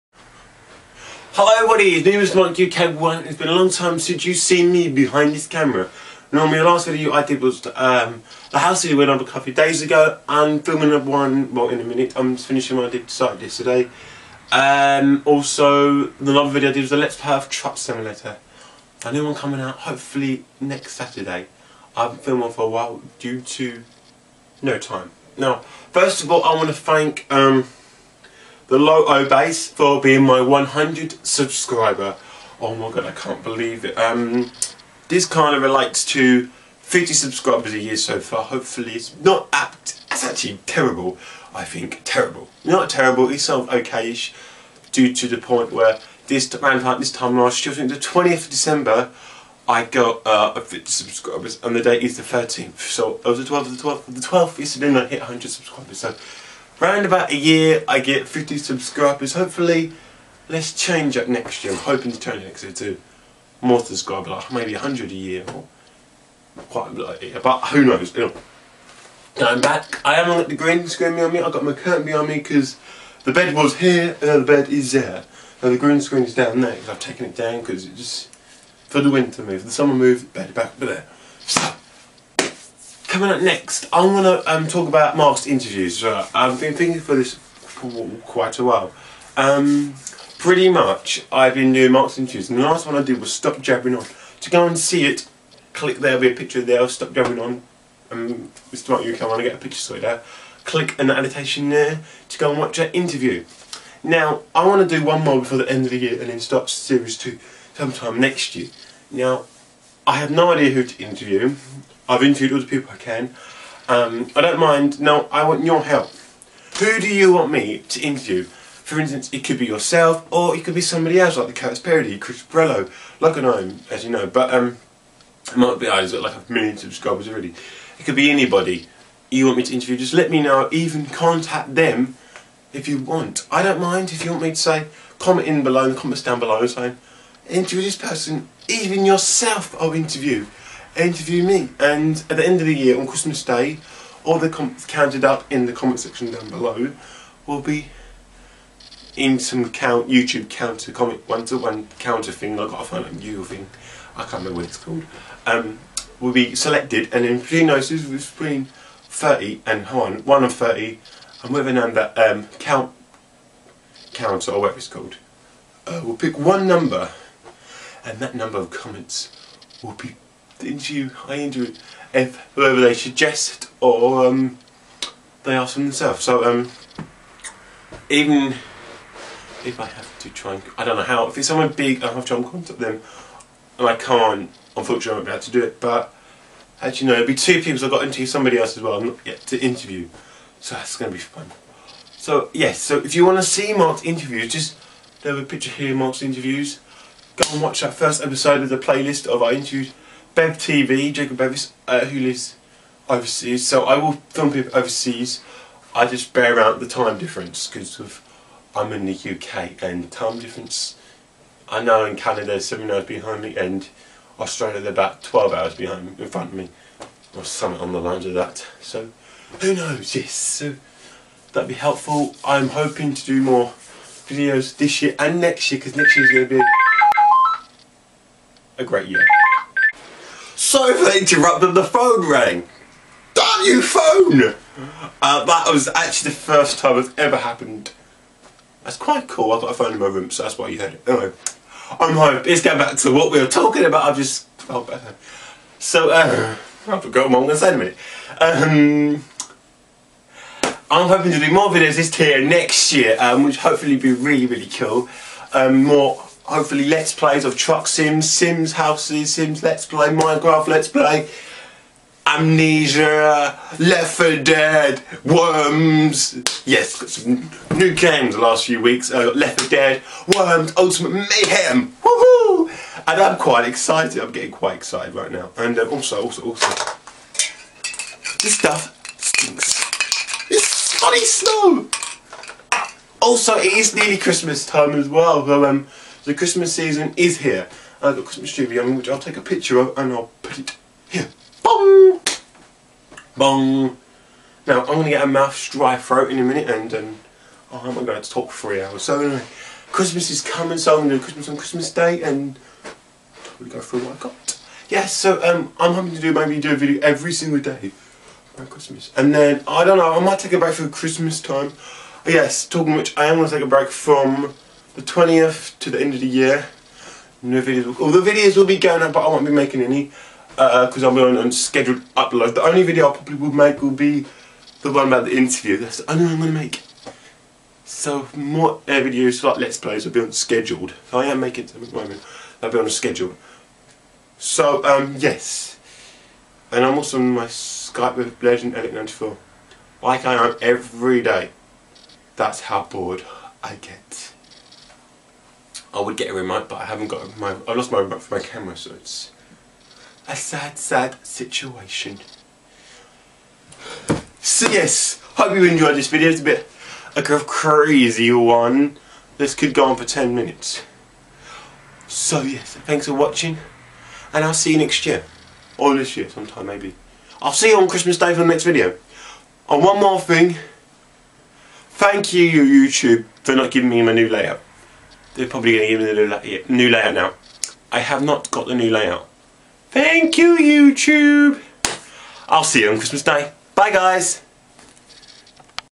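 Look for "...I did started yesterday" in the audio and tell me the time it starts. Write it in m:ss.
0:12.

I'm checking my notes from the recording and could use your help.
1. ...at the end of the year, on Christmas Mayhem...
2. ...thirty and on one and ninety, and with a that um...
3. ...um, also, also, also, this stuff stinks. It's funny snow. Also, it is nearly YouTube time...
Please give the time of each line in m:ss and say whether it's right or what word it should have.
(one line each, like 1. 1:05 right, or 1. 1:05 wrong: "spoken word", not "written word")
1. 2:22 wrong: "Day", not "Mayhem"
2. 2:39 wrong: "thirty", not "ninety"
3. 4:35 wrong: "Christmas", not "YouTube".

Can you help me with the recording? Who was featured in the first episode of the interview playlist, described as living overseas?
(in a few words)
Jacob Bevis.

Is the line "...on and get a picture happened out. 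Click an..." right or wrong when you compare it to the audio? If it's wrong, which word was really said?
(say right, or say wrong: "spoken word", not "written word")
wrong: "sorted", not "happened".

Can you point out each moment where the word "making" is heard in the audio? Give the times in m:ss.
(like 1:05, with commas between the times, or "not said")
5:19, 5:31.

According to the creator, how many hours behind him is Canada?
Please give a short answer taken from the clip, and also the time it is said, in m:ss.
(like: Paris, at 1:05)
7, at 3:32.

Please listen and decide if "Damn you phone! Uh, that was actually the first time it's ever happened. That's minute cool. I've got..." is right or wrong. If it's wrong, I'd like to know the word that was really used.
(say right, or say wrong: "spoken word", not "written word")
wrong: "quite", not "minute".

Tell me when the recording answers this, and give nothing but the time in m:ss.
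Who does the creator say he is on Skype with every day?
5:38.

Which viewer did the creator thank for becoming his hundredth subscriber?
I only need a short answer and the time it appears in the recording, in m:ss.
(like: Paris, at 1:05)
The Low O Bass, at 0:28.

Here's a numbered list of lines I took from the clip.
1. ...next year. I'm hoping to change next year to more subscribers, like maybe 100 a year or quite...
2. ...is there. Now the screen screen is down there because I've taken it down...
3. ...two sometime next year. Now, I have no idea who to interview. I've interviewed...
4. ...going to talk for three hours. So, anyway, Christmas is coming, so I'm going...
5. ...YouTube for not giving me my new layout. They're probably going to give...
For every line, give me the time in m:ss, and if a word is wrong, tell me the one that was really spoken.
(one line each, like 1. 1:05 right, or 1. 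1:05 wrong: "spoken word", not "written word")
1. 1:01 right
2. 1:14 wrong: "green", not "screen"
3. 1:47 right
4. 4:58 right
5. 6:12 right.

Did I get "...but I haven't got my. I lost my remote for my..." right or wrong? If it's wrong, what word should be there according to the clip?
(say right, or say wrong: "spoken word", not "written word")
right.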